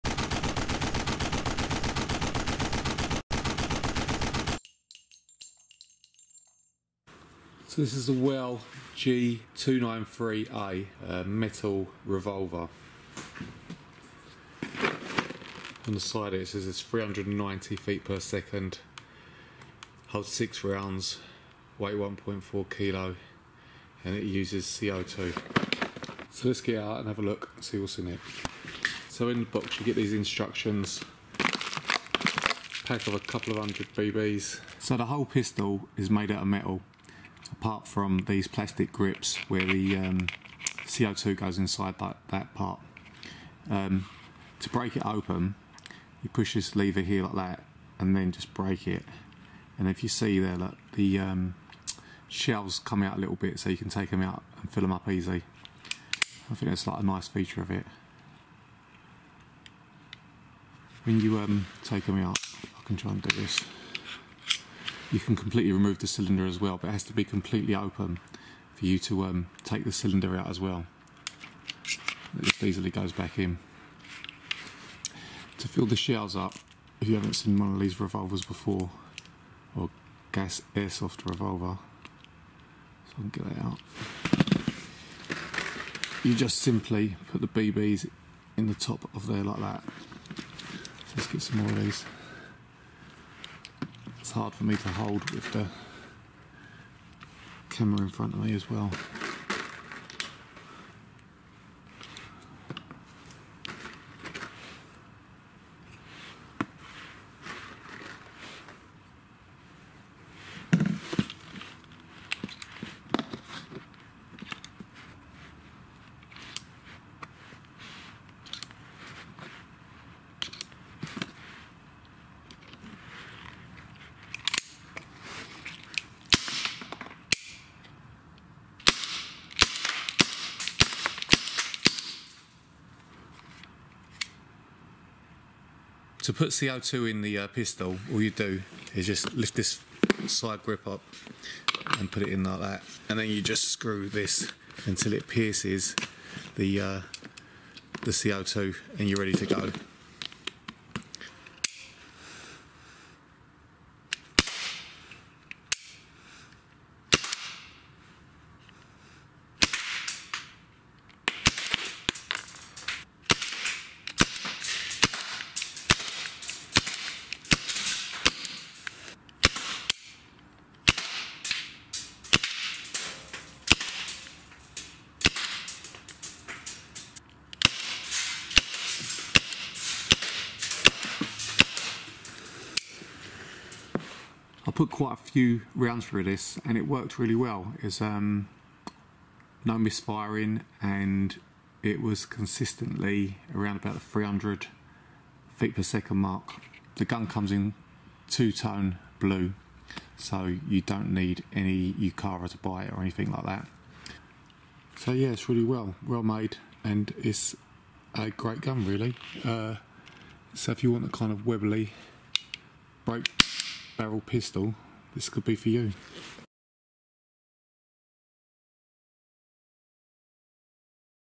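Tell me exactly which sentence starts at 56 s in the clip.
I think that's like a nice feature of it.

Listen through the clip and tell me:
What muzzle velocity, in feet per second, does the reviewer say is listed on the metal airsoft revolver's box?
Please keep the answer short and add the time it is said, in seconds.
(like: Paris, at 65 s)
390, at 16 s.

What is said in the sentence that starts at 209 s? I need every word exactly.
Uh, so if you want a kind of Webley break barrel pistol, this could be for you.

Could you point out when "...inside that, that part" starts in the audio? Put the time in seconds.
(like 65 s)
41 s.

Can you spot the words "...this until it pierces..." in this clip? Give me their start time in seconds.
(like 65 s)
144 s.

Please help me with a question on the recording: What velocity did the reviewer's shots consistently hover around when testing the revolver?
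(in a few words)
300 feet per second.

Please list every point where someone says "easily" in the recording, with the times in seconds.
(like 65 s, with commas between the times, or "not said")
72 s.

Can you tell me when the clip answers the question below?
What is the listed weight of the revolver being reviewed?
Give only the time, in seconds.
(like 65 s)
21 s.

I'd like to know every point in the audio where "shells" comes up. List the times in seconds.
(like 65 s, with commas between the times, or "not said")
52 s, 75 s.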